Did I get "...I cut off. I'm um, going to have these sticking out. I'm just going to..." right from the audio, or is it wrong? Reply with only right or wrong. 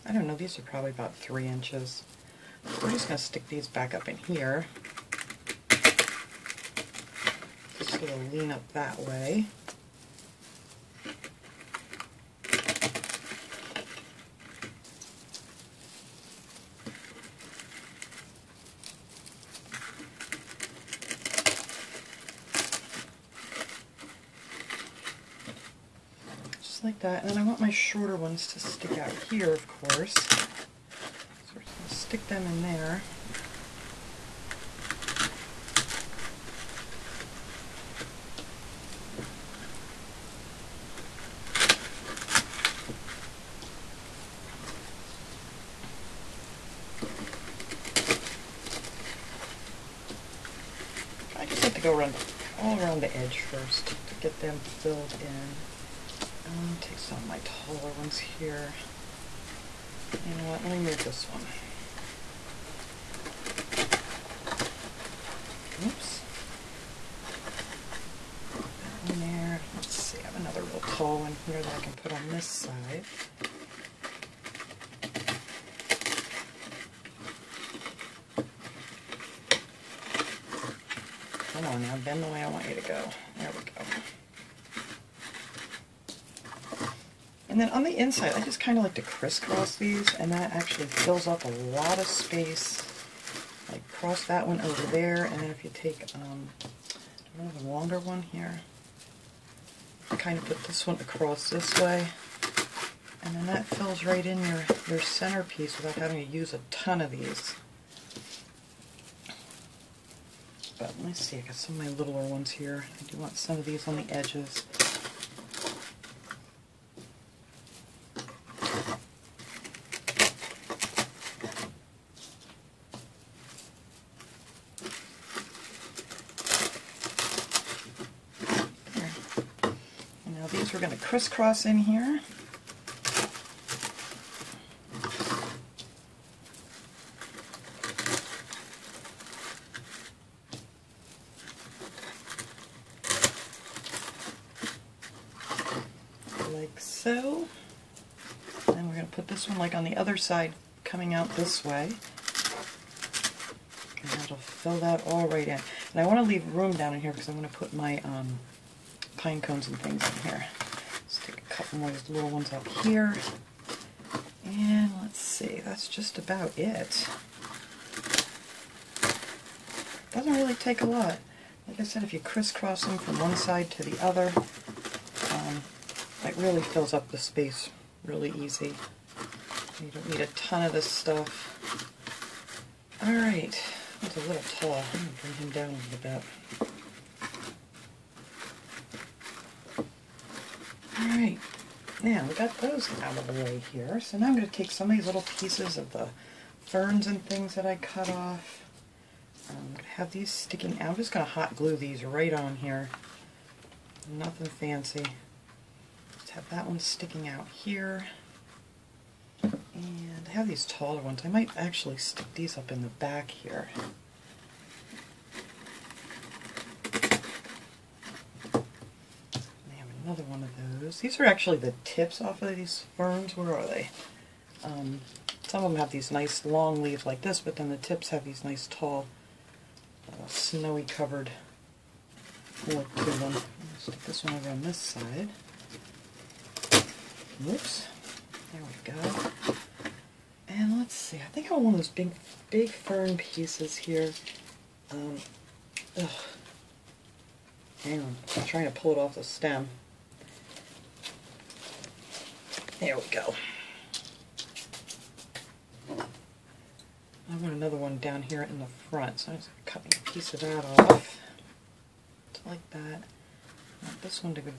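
right.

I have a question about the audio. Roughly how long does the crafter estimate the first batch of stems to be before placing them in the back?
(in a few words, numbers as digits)
3 inches.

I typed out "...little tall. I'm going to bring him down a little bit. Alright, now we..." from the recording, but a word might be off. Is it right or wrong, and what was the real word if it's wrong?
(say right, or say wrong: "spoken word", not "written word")
right.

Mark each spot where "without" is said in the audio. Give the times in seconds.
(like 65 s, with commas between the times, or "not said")
105 s.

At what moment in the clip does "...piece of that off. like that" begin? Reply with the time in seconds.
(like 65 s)
260 s.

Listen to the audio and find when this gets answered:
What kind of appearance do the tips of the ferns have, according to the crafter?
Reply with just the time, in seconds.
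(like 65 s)
230 s.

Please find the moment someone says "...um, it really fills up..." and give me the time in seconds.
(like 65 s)
175 s.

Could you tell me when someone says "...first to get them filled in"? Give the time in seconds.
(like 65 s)
53 s.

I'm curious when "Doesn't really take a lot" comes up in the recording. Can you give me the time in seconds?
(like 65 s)
170 s.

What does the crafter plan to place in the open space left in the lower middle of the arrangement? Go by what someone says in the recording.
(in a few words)
pine cones.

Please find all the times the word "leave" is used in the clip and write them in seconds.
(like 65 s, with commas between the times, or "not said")
156 s, 226 s.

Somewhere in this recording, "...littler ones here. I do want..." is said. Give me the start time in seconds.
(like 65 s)
111 s.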